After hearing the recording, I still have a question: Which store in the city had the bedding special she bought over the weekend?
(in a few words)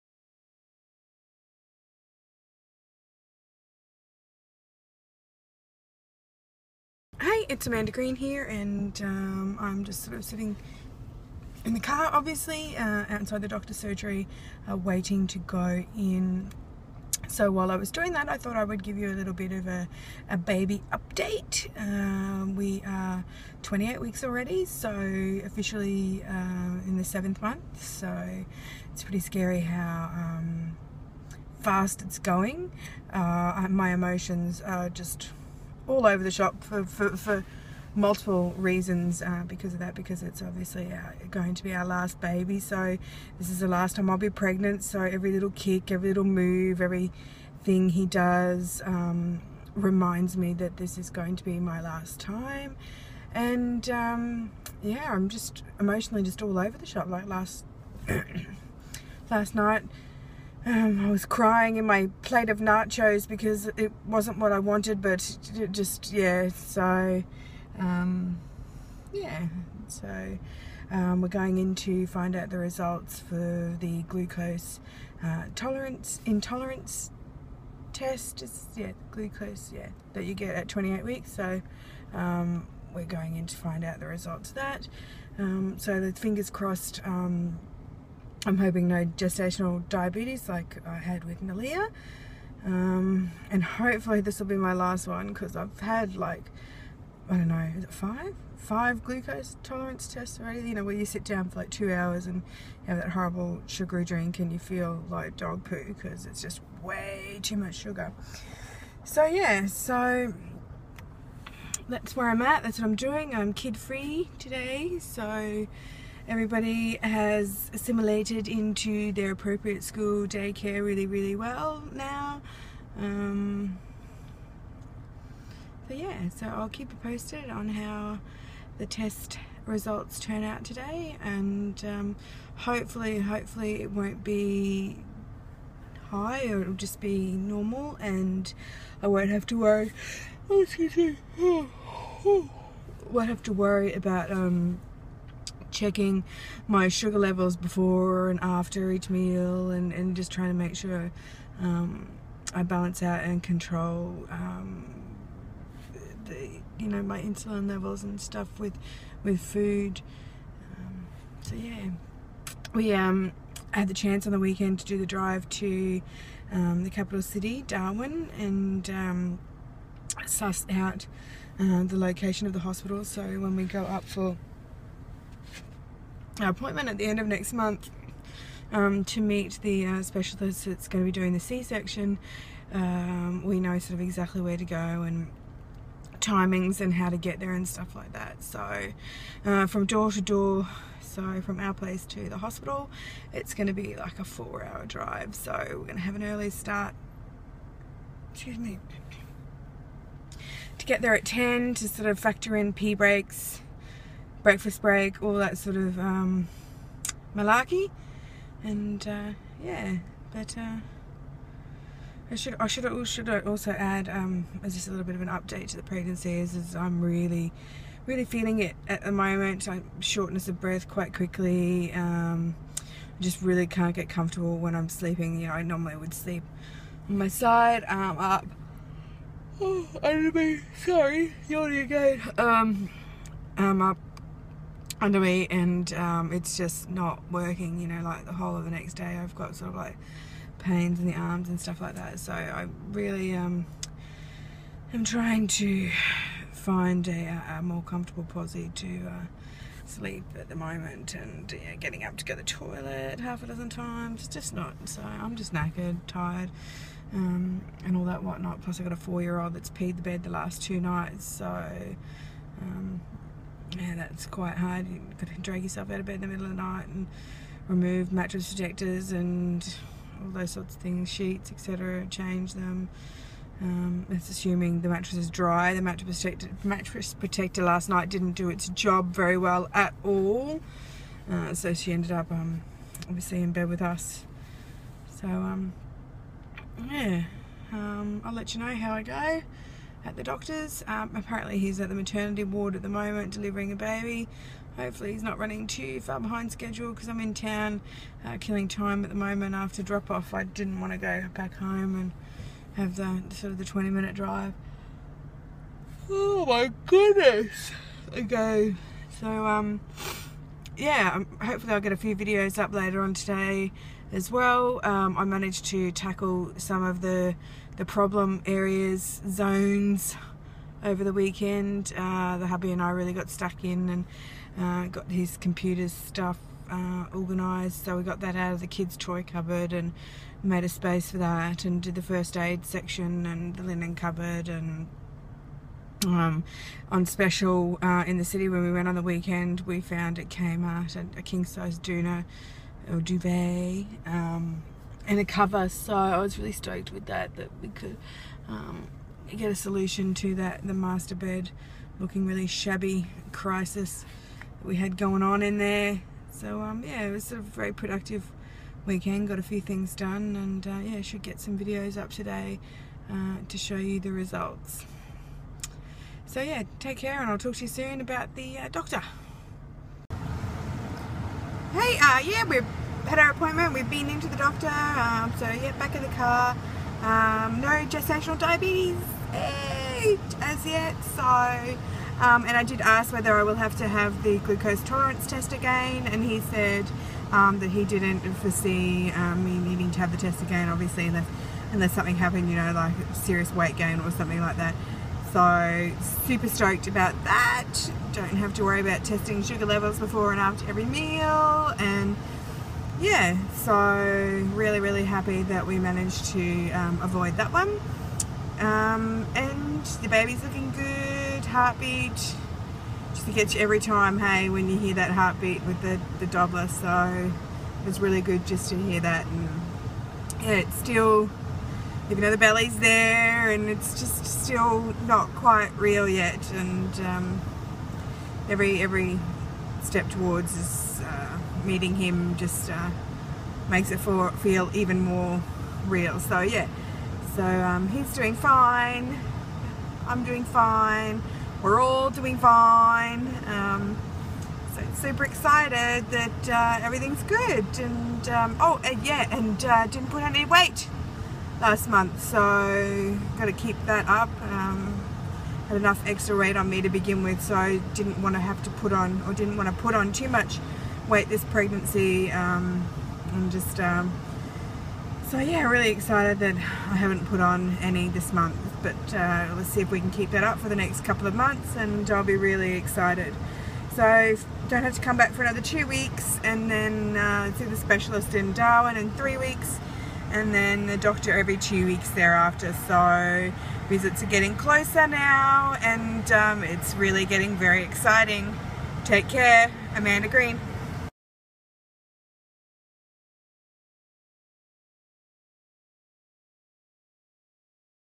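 Kmart.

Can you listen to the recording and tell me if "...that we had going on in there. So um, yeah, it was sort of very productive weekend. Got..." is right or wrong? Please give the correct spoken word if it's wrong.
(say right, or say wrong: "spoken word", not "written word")
right.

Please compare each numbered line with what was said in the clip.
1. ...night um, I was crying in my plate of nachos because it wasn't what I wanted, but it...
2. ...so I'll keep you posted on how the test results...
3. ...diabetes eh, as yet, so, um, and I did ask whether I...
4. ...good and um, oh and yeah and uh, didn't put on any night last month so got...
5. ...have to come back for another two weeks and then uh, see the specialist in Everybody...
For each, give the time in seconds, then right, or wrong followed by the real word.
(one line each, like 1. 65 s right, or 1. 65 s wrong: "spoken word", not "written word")
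1. 59 s right
2. 126 s right
3. 378 s right
4. 447 s wrong: "weight", not "night"
5. 474 s wrong: "Darwin", not "Everybody".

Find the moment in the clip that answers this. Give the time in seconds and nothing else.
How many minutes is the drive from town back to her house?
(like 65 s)
303 s.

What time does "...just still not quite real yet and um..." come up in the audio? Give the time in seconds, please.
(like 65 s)
423 s.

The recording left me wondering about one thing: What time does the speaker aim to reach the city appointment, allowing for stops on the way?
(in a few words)
10.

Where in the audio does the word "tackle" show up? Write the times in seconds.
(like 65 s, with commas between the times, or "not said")
315 s.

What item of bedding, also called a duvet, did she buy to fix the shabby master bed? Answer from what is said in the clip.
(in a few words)
doona.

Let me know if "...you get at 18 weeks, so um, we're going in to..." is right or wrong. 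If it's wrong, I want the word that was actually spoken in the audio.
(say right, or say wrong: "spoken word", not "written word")
wrong: "28", not "18".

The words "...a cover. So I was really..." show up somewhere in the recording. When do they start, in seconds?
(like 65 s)
345 s.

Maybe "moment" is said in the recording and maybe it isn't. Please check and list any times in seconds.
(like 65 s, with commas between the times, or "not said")
219 s, 250 s, 292 s, 299 s.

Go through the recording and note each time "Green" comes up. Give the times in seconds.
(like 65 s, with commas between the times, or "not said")
7 s, 490 s.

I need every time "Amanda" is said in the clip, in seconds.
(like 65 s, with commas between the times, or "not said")
7 s, 489 s.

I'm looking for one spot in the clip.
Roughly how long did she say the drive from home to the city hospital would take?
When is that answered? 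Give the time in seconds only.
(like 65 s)
194 s.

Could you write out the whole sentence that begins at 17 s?
So while I was doing that, I thought I would give you a little bit of a, a baby update.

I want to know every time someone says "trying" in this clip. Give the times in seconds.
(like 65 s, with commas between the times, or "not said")
150 s, 245 s.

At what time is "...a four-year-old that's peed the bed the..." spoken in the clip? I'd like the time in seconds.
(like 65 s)
258 s.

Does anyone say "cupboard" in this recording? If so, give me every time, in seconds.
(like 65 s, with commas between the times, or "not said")
329 s, 333 s.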